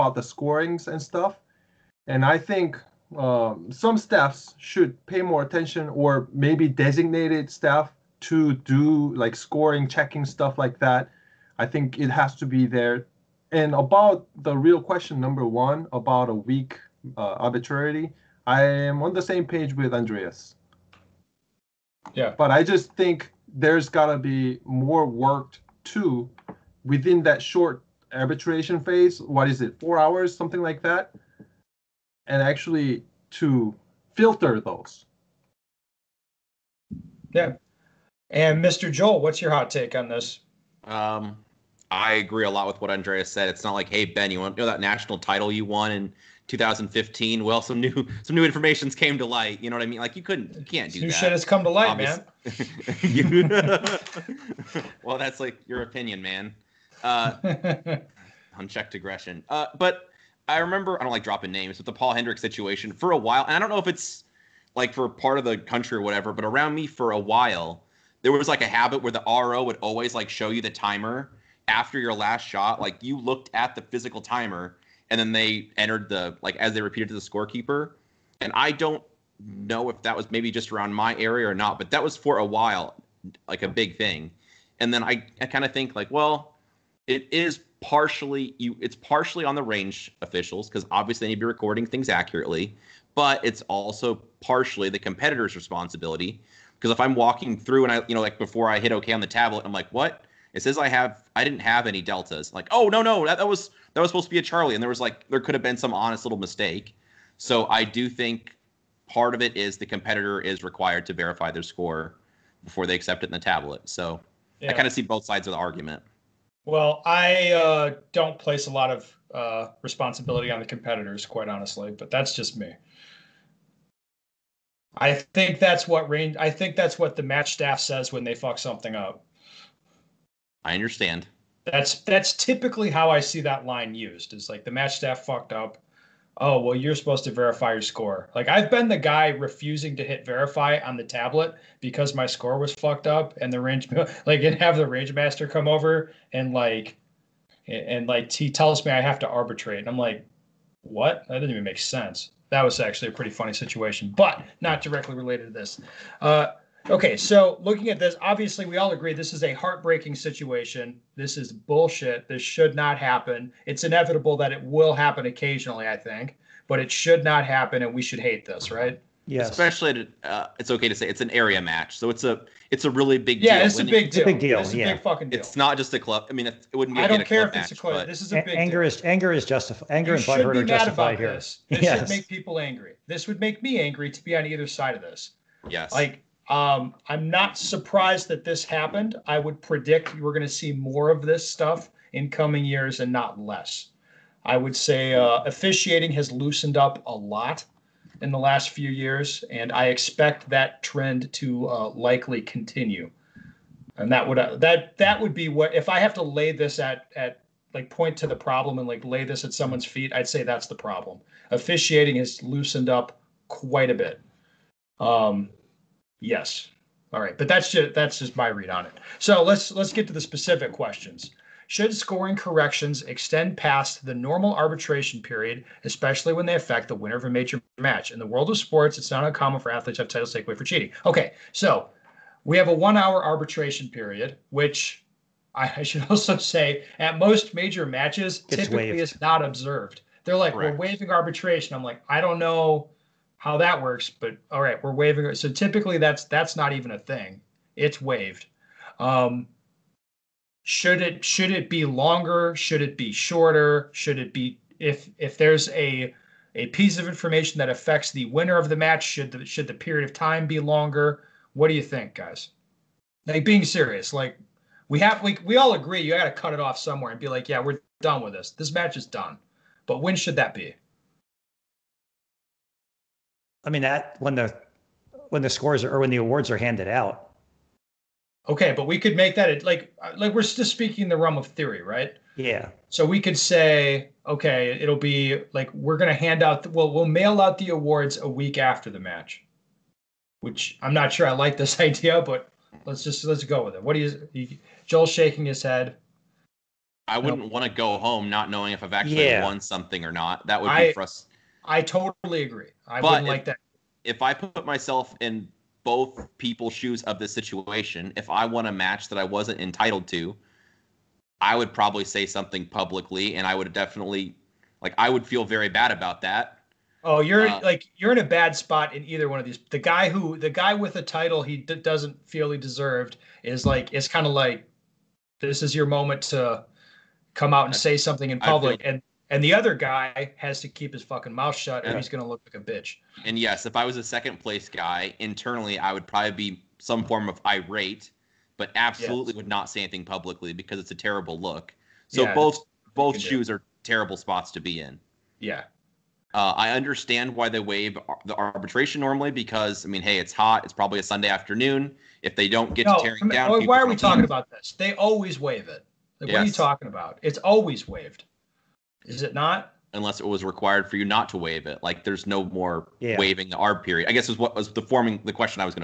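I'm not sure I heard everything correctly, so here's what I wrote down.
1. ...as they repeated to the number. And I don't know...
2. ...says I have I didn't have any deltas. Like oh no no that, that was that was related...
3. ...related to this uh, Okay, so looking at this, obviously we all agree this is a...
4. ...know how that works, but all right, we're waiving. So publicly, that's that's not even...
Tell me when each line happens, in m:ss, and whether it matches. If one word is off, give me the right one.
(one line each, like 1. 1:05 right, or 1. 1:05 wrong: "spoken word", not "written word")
1. 1:16 wrong: "scorekeeper", not "number"
2. 1:40 wrong: "supposed", not "related"
3. 2:35 right
4. 4:02 wrong: "typically", not "publicly".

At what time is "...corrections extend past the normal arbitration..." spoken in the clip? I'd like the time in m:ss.
3:42.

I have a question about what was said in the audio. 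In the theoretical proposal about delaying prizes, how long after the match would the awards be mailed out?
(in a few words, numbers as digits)
a week.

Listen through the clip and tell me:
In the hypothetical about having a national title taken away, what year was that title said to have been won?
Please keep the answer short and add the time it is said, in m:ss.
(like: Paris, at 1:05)
2015, at 0:46.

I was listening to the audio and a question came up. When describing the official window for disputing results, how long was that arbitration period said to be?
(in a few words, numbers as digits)
1 hour.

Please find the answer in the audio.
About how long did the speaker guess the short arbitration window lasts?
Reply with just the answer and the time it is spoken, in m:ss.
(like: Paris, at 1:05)
4 hours, at 0:29.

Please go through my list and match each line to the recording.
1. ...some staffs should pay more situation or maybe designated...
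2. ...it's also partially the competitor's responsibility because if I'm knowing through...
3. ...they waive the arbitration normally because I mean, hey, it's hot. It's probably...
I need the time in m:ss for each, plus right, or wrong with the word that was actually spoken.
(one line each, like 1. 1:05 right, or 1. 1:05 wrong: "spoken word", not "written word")
1. 0:03 wrong: "attention", not "situation"
2. 1:33 wrong: "walking", not "knowing"
3. 5:47 right.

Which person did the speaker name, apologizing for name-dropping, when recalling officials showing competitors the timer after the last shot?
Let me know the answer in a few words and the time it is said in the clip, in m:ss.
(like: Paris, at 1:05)
Paul Hendricks, at 1:01.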